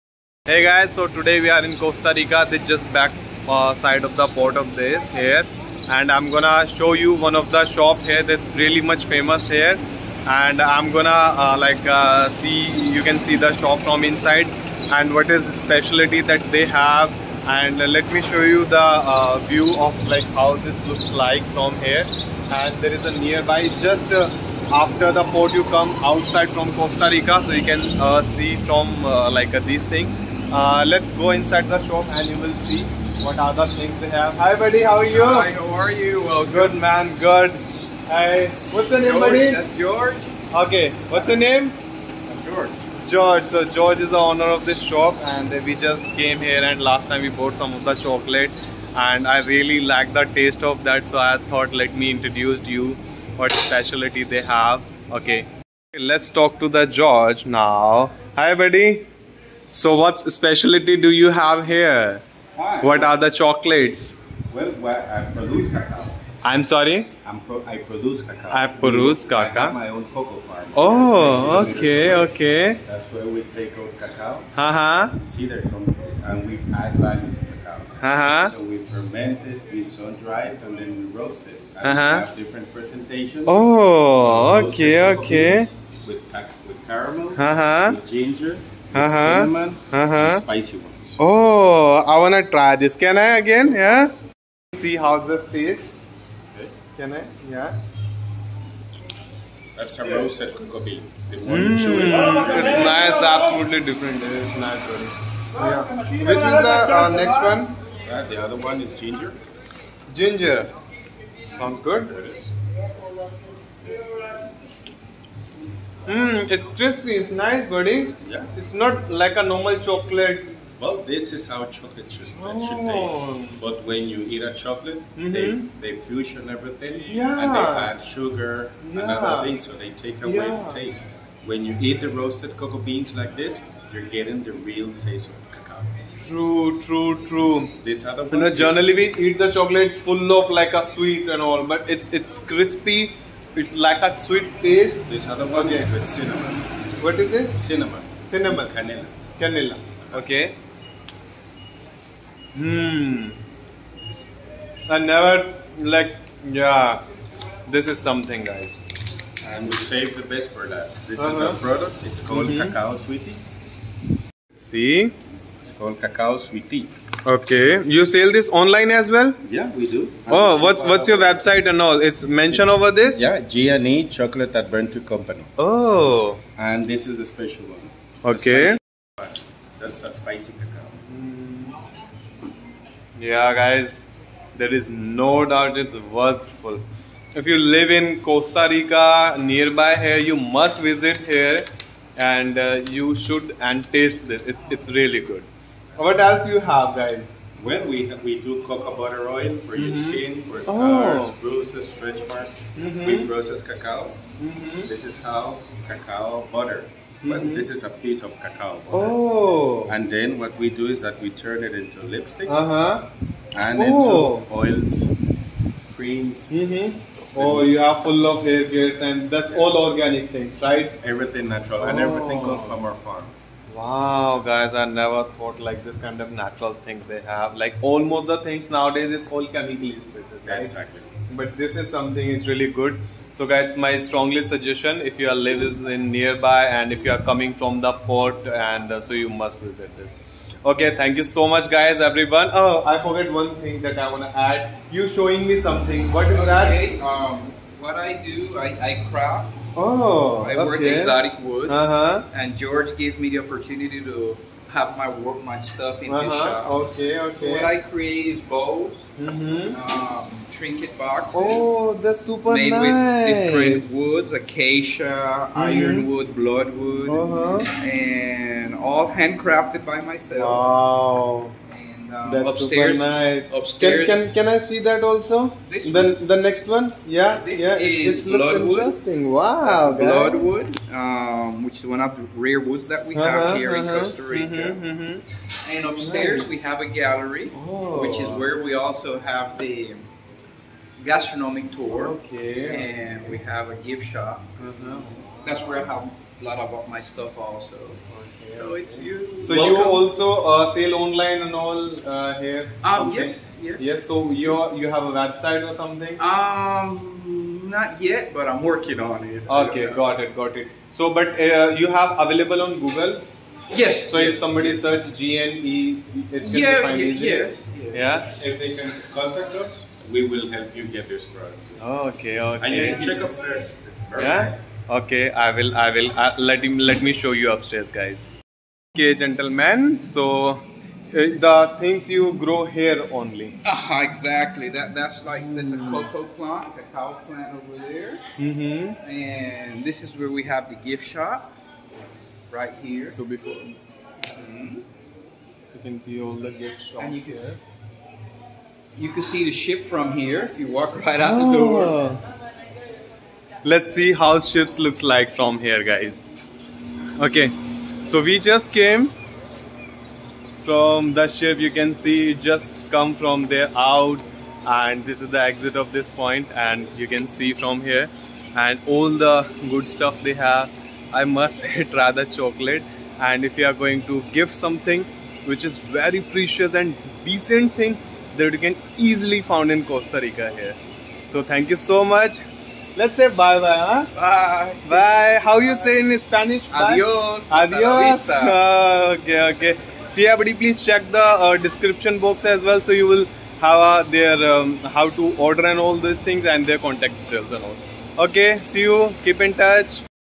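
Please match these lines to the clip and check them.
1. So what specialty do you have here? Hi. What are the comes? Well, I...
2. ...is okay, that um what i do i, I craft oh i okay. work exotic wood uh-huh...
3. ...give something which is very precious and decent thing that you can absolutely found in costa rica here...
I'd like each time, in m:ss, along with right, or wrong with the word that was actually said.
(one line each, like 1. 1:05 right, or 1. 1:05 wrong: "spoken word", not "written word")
1. 0:59 wrong: "chocolates", not "comes"
2. 4:06 right
3. 6:14 wrong: "easily", not "absolutely".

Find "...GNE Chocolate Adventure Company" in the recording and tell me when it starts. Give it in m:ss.
2:53.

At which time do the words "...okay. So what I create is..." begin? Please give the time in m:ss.
4:17.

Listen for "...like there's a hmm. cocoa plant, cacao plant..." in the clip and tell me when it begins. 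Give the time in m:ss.
5:35.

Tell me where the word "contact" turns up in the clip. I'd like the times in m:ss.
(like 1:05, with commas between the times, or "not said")
5:19, 6:36.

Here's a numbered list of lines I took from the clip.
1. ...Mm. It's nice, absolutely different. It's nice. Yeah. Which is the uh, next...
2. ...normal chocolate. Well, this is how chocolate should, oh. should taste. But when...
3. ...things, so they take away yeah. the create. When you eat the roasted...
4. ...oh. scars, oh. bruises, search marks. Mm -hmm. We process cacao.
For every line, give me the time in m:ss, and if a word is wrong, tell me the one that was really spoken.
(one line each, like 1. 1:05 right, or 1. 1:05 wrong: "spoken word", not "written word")
1. 1:41 right
2. 1:59 right
3. 2:09 wrong: "taste", not "create"
4. 3:20 wrong: "stretch", not "search".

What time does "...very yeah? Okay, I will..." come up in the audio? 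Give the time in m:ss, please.
5:24.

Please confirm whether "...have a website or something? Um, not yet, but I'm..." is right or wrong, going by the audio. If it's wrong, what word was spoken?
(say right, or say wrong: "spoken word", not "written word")
right.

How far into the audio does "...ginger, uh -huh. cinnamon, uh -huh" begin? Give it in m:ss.
1:28.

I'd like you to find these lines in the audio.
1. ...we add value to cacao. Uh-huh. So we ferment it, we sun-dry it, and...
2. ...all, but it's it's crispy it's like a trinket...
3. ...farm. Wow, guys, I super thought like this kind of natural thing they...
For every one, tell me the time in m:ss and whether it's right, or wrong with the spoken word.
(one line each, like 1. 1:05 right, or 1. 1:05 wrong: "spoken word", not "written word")
1. 1:16 right
2. 2:21 wrong: "sweet", not "trinket"
3. 3:43 wrong: "never", not "super".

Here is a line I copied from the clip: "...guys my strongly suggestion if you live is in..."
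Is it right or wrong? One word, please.
right.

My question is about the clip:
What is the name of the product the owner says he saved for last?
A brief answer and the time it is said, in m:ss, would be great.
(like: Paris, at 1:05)
Cacao sweetie, at 2:42.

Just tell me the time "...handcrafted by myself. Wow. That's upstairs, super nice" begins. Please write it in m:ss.
4:29.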